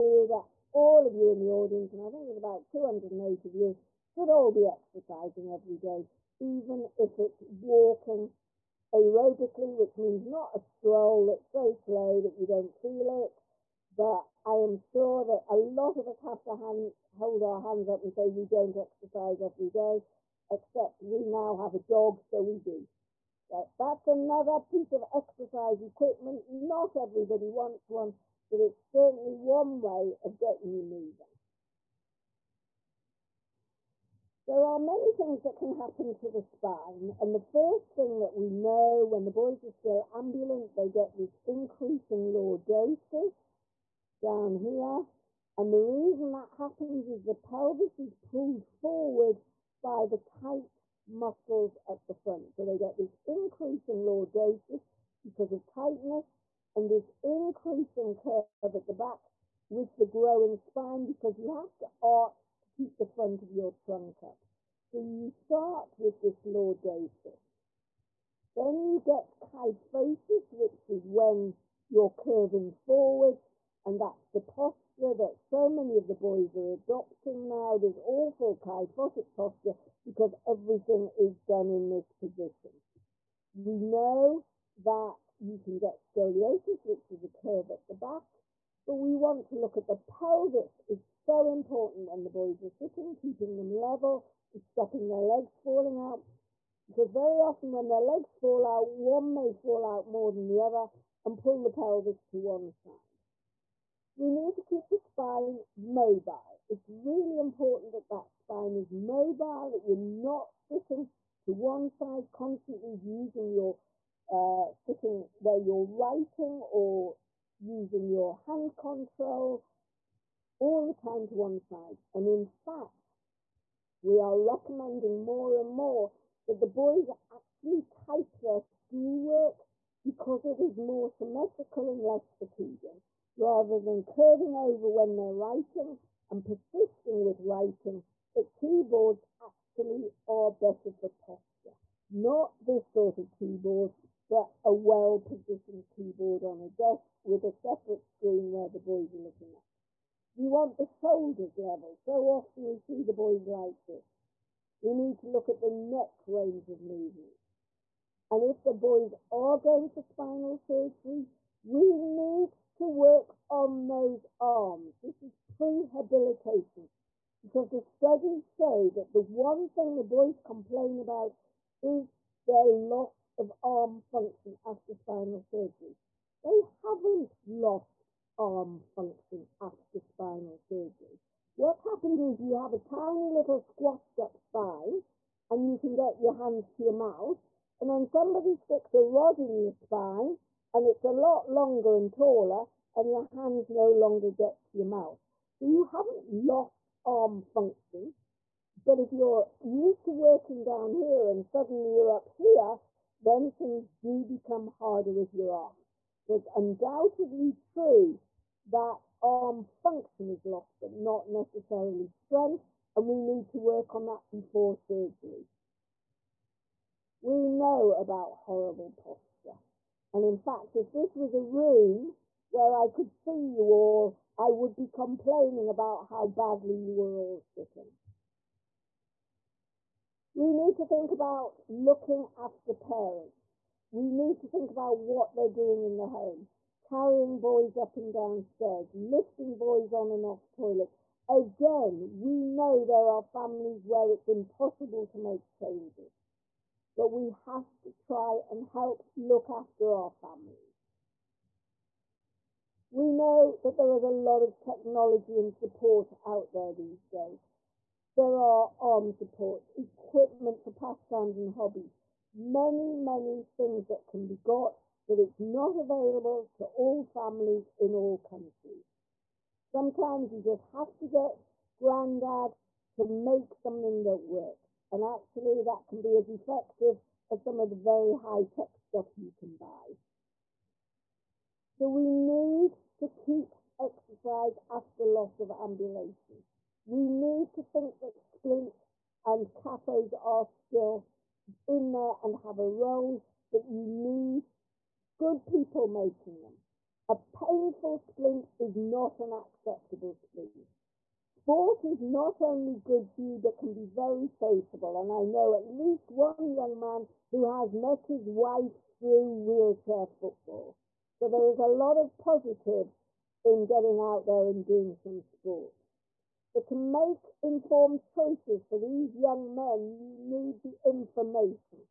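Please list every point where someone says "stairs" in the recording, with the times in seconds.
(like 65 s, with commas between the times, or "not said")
238 s.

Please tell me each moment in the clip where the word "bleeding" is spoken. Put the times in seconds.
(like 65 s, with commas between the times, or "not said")
not said.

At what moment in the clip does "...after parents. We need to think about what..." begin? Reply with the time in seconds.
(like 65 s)
232 s.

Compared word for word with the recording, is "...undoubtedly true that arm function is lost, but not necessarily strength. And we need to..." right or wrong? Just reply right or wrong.
right.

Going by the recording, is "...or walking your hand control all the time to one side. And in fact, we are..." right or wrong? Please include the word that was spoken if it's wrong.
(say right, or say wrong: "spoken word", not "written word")
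wrong: "using", not "walking".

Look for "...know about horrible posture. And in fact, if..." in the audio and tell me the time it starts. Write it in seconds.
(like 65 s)
217 s.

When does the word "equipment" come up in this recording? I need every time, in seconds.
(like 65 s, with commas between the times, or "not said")
25 s, 259 s.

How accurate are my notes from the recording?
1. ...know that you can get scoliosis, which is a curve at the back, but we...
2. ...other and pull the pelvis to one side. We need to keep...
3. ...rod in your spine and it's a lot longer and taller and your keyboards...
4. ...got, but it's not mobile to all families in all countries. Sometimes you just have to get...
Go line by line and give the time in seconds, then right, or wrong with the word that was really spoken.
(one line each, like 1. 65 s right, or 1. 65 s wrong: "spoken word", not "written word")
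1. 83 s right
2. 100 s right
3. 189 s wrong: "hands", not "keyboards"
4. 264 s wrong: "available", not "mobile".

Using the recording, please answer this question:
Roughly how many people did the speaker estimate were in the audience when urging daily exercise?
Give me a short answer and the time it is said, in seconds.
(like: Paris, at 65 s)
208, at 2 s.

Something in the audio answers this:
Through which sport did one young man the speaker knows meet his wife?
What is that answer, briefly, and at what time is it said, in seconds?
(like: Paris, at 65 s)
wheelchair football, at 309 s.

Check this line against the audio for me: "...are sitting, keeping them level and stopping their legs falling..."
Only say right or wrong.
right.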